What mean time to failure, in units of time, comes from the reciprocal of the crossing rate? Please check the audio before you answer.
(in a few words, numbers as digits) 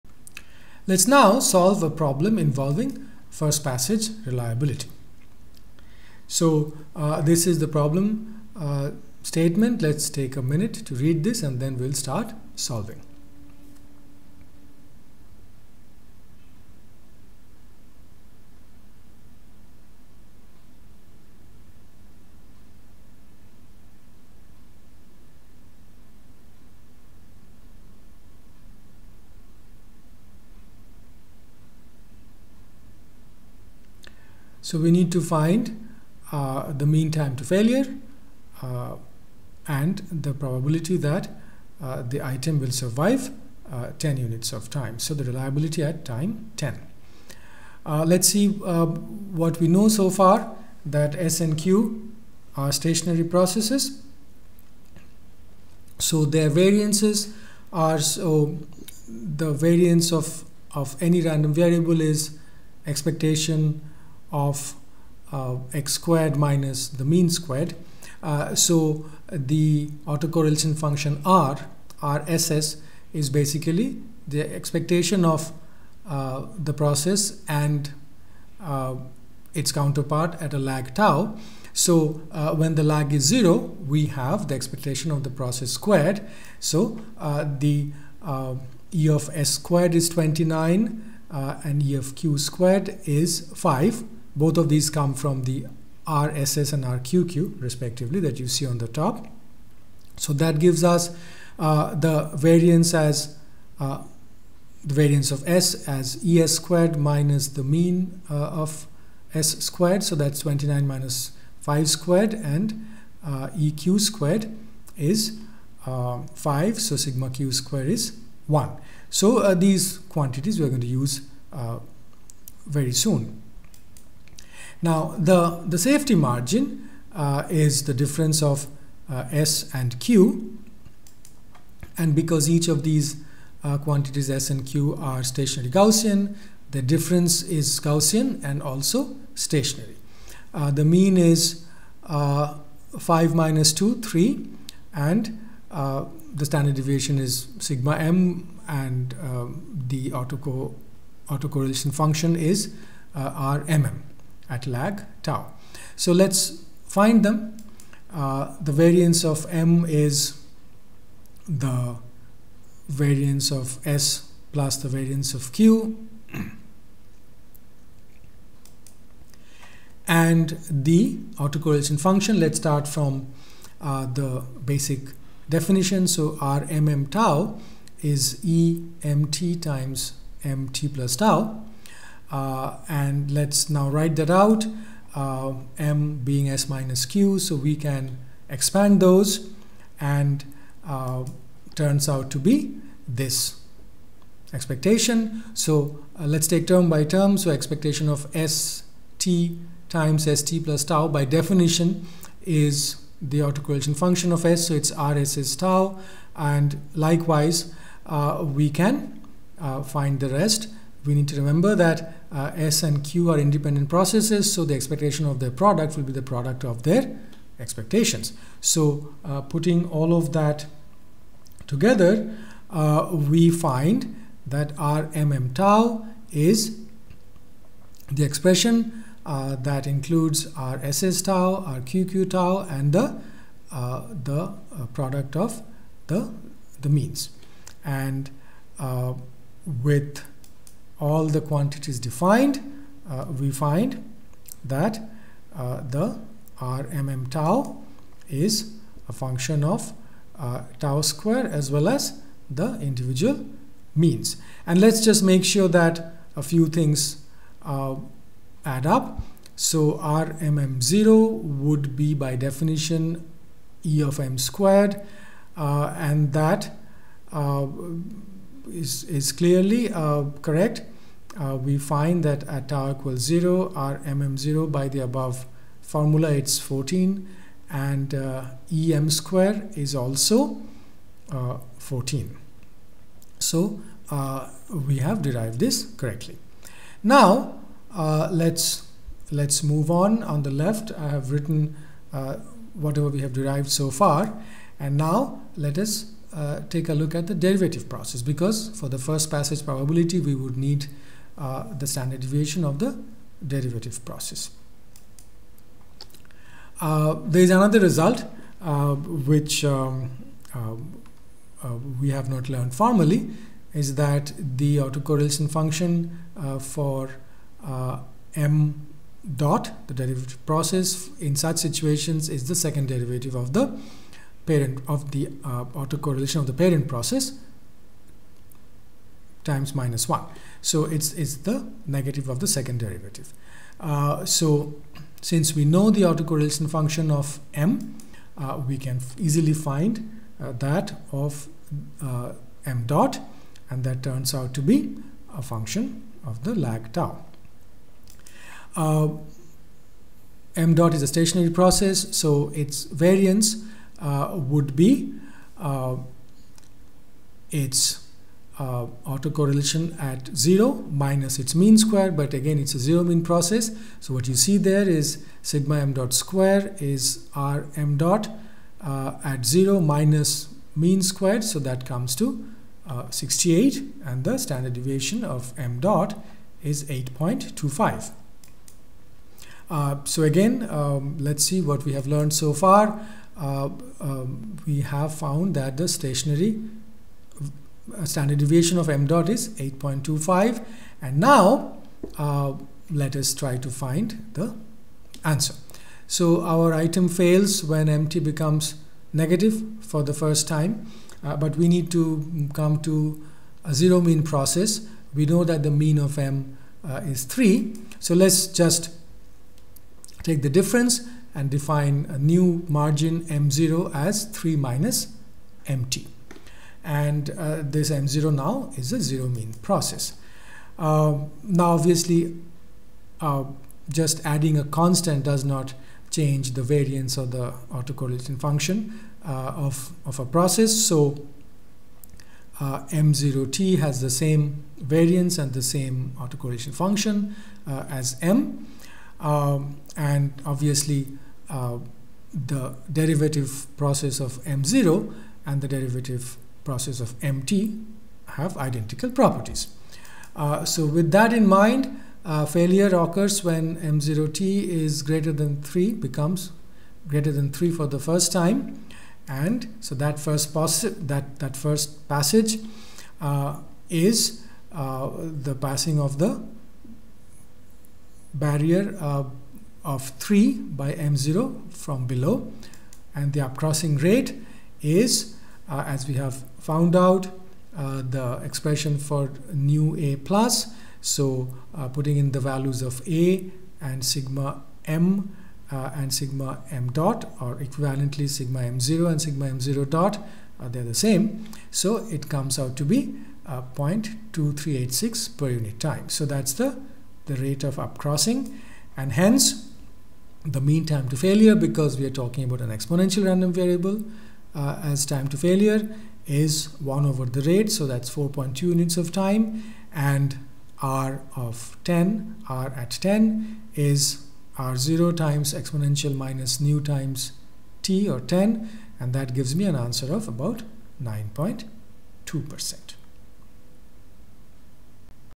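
4.2.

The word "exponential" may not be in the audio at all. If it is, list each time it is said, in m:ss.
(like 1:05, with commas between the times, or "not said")
8:22, 8:35.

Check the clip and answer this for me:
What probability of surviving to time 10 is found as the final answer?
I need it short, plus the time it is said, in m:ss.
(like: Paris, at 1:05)
about 9.2%, at 8:41.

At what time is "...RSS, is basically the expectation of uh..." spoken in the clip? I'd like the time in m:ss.
1:12.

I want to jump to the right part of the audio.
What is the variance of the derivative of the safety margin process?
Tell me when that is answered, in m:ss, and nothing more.
6:13.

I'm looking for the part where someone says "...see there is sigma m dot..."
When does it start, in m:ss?
6:04.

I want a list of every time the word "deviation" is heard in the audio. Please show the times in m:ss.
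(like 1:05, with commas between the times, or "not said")
2:26, 5:02, 6:14, 6:28.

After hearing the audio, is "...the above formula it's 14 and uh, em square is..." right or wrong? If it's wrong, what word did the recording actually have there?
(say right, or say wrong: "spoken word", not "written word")
right.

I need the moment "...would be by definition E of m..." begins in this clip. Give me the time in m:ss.
4:21.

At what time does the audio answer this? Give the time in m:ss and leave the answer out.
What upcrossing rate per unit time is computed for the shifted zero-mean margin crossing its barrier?
8:13.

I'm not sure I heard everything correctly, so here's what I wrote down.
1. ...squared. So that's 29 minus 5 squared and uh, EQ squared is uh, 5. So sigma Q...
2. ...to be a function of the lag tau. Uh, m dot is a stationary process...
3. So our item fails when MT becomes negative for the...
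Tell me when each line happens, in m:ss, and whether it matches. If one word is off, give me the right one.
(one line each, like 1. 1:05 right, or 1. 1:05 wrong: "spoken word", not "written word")
1. 1:49 right
2. 5:44 right
3. 6:36 right.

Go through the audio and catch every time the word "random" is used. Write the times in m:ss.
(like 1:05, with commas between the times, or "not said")
1:01, 8:23.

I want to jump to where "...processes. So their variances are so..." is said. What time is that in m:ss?
0:53.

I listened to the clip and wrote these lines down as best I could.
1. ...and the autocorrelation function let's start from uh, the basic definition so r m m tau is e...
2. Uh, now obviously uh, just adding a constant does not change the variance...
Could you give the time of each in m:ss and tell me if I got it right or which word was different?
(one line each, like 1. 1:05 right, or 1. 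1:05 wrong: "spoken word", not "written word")
1. 2:50 right
2. 7:00 right.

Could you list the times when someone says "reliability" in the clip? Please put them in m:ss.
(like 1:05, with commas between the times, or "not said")
0:04, 0:45.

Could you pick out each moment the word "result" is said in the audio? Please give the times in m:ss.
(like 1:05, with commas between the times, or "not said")
5:07.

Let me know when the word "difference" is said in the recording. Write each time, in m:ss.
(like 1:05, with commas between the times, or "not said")
2:07, 2:16, 6:50.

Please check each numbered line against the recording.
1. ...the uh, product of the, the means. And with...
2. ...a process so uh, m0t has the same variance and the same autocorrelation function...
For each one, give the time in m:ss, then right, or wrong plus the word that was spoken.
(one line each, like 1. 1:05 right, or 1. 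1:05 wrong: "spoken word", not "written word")
1. 3:54 right
2. 7:10 right.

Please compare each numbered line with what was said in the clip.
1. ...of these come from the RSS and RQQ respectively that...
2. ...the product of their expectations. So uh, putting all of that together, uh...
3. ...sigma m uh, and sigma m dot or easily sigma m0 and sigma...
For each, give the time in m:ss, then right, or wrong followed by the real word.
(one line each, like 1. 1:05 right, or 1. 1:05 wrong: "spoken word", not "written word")
1. 1:34 right
2. 3:36 right
3. 8:04 wrong: "equivalently", not "easily".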